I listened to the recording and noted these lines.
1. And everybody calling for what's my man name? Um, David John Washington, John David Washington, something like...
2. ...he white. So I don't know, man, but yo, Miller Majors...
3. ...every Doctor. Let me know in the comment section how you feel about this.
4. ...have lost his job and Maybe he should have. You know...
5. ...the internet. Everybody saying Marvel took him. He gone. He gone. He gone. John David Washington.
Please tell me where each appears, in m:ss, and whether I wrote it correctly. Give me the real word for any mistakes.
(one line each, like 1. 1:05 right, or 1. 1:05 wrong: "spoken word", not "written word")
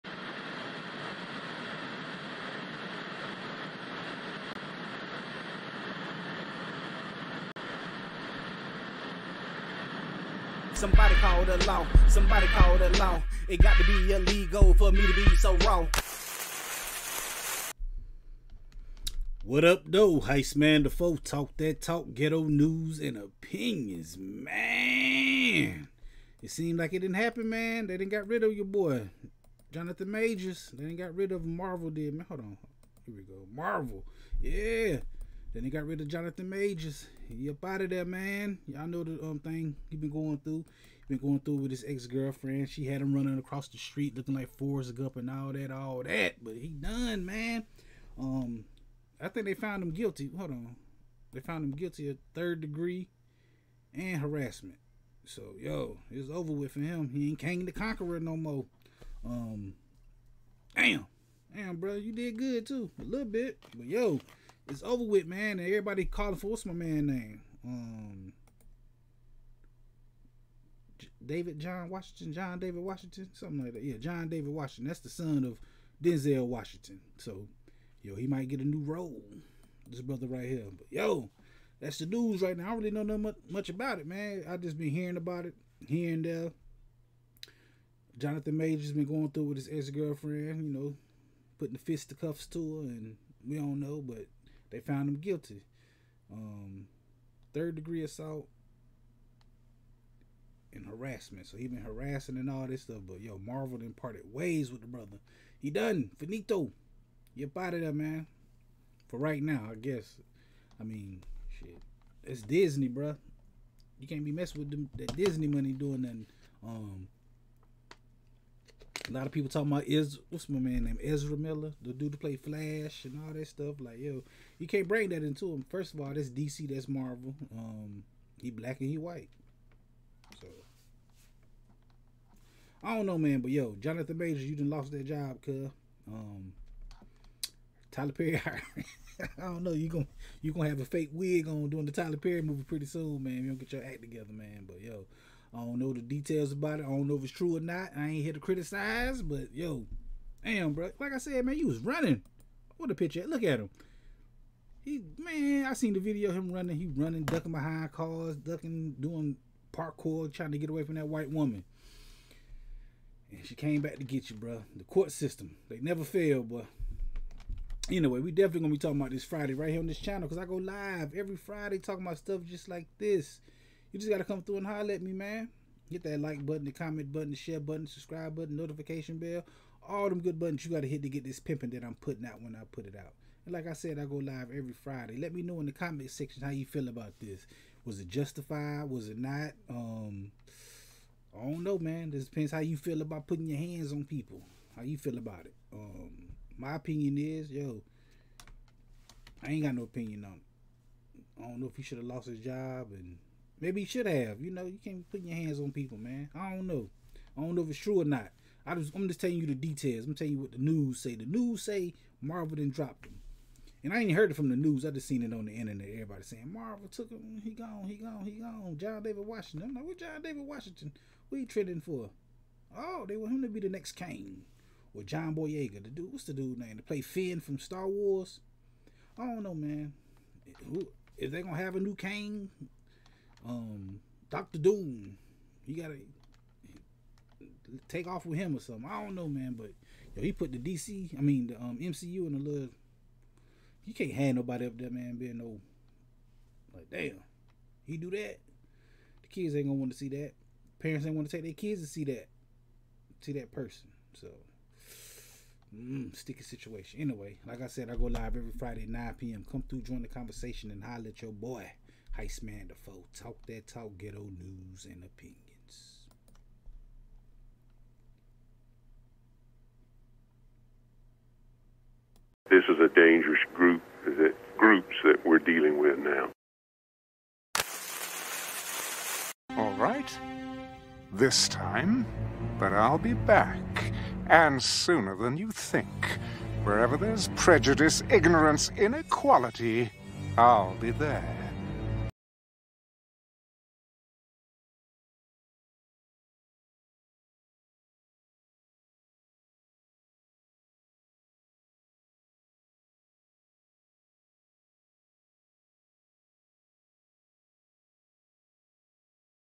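1. 1:05 right
2. 2:08 wrong: "Jonathan", not "Miller"
3. 3:04 wrong: "Friday", not "Doctor"
4. 3:21 right
5. 3:35 right.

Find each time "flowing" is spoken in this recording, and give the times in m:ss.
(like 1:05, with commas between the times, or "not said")
not said.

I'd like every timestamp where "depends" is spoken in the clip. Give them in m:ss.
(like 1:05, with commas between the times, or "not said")
3:12.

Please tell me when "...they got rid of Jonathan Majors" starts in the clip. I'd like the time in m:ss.
0:35.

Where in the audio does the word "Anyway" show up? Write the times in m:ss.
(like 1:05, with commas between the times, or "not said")
2:47, 4:16.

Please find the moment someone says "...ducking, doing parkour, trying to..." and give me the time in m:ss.
2:38.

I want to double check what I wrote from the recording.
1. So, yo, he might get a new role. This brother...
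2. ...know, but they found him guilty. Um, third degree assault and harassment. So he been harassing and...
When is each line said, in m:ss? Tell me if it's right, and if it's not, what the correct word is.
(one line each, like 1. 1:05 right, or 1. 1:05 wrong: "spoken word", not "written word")
1. 1:17 right
2. 1:33 right.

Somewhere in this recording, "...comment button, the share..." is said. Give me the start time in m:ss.
2:56.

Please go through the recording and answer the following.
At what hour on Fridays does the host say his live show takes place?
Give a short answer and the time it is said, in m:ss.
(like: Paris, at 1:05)
9 p.m., at 4:18.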